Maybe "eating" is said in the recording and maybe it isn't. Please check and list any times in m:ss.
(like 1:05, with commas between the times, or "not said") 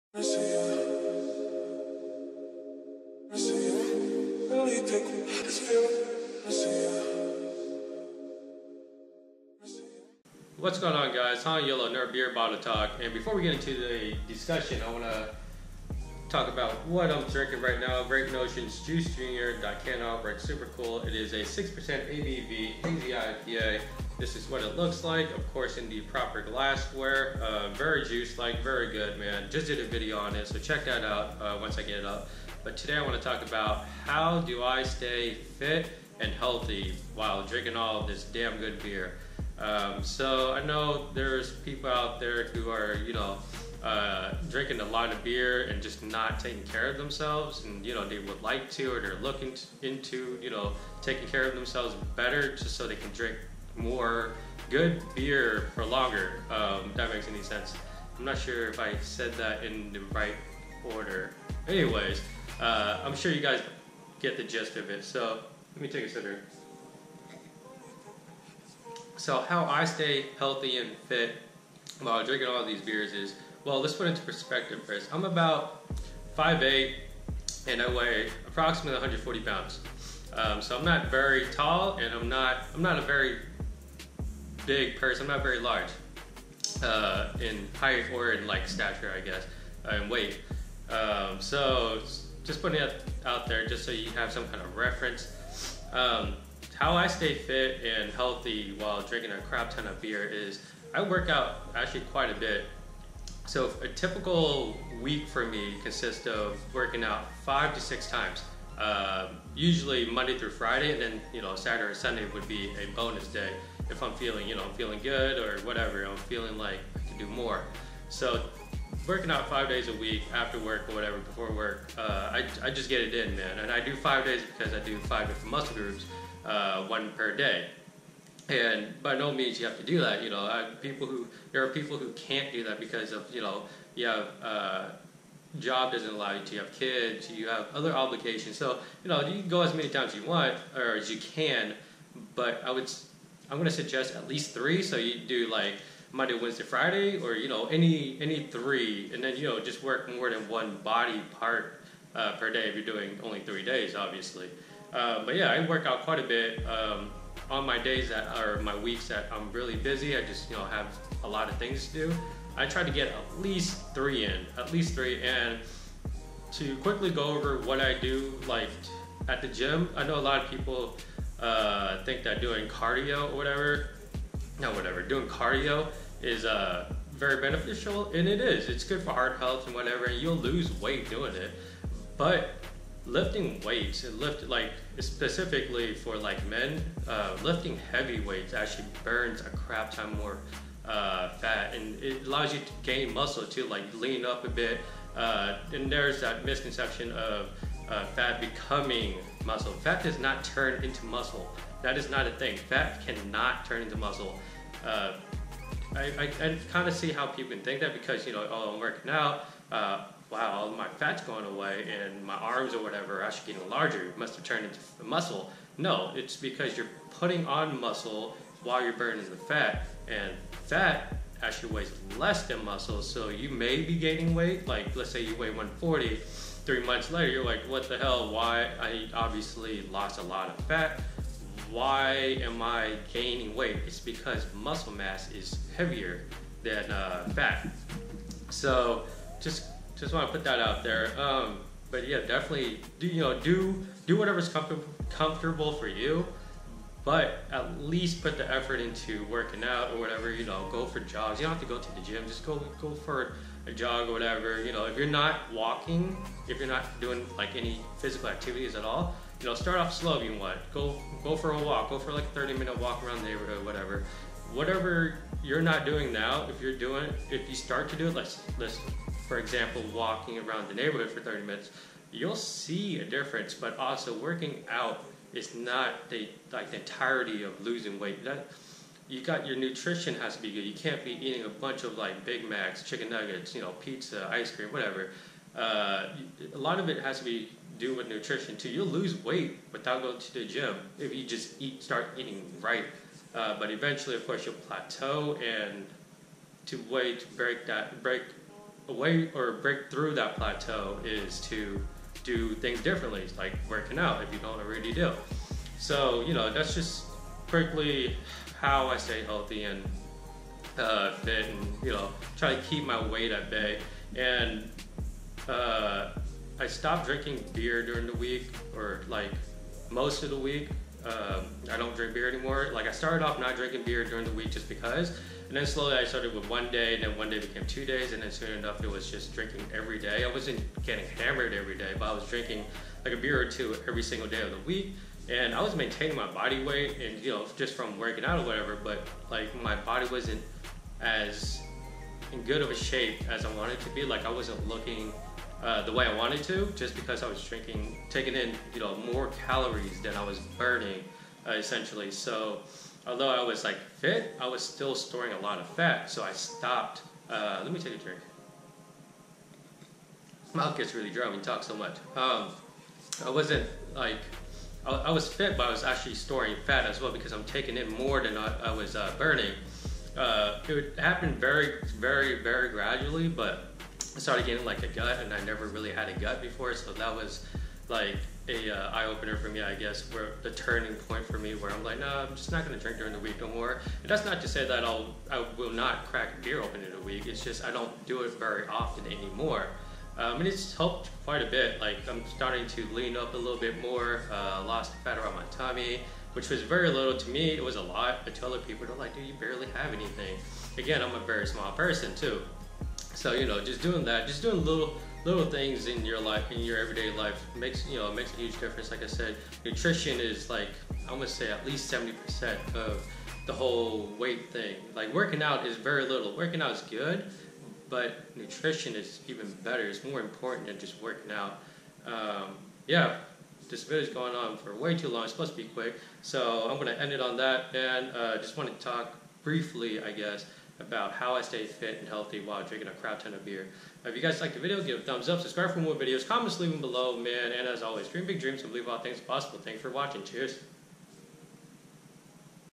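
4:41, 4:52.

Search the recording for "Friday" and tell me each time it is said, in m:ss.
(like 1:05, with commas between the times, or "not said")
1:50, 2:26.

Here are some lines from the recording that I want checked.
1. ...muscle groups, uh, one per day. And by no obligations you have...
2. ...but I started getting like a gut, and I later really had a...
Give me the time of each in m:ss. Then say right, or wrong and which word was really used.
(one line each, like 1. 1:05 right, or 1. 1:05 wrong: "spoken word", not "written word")
1. 2:05 wrong: "means", not "obligations"
2. 6:13 wrong: "never", not "later".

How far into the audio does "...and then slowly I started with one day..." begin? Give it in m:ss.
5:25.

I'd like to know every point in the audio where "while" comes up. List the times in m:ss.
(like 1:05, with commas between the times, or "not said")
0:37, 1:12, 1:38, 3:38, 7:12.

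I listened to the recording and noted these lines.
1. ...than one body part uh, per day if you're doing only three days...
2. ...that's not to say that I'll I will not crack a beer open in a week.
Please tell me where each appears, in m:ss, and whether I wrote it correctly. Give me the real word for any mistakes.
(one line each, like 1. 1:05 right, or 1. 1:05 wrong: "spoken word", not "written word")
1. 2:30 right
2. 6:24 right.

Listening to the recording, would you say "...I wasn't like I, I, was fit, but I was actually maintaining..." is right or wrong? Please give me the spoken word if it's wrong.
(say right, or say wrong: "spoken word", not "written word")
wrong: "storing", not "maintaining".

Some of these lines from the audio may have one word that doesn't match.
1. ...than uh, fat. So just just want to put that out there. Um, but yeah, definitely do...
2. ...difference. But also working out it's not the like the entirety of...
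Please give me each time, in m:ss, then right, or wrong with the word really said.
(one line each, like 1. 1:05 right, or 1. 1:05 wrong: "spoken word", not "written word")
1. 3:56 right
2. 4:33 right.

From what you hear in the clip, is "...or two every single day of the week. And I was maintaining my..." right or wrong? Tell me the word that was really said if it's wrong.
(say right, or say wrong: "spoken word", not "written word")
right.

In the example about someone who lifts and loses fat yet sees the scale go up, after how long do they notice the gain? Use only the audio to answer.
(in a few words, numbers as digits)
3 months.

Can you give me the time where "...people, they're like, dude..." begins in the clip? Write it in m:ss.
6:38.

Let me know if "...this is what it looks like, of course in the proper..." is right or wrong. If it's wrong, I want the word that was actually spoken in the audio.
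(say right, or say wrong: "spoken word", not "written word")
right.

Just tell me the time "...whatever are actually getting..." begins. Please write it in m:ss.
3:32.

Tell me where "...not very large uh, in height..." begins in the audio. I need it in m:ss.
1:25.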